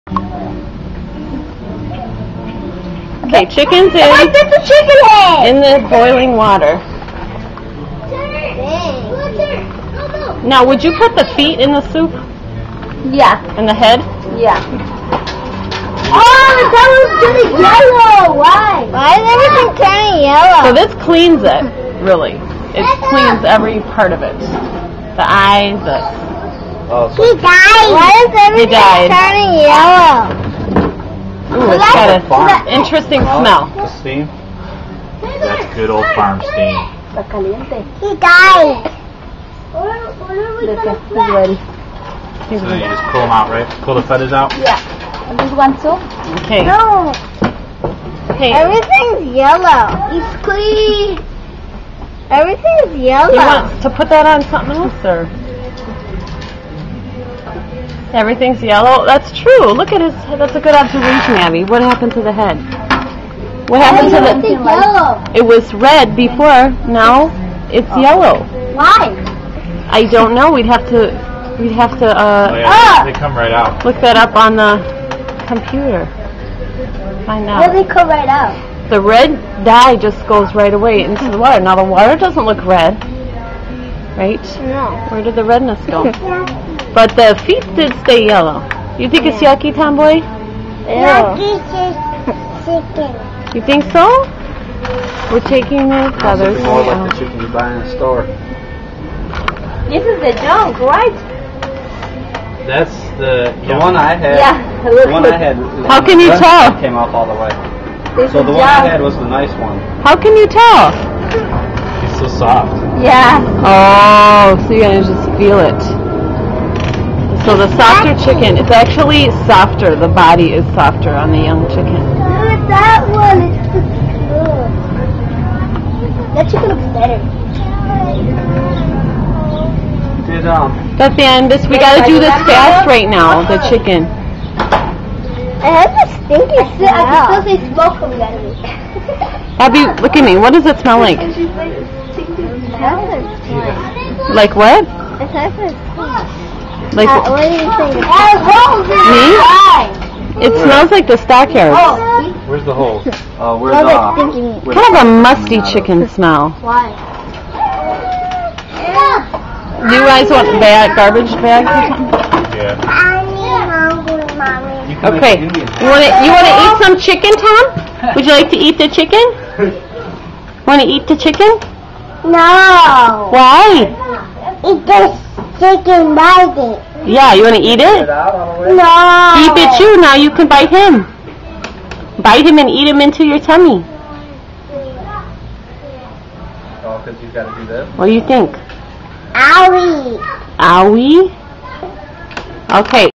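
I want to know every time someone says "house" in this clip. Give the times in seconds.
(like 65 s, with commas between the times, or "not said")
not said.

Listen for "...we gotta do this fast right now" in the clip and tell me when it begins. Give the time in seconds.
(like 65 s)
131 s.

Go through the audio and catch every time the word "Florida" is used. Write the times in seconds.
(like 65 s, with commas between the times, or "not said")
not said.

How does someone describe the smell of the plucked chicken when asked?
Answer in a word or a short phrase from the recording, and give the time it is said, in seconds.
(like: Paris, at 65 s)
Musty, at 155 s.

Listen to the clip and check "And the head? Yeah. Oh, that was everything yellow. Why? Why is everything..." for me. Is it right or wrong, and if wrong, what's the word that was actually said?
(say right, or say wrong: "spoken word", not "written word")
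wrong: "turning", not "everything".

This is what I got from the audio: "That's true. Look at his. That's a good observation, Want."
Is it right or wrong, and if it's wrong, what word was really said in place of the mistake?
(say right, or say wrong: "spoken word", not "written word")
wrong: "Abby", not "Want".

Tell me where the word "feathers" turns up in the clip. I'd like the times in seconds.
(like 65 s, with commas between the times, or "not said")
44 s, 96 s.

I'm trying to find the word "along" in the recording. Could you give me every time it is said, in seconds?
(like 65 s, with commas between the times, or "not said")
not said.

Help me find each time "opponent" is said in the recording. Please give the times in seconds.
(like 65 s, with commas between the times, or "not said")
not said.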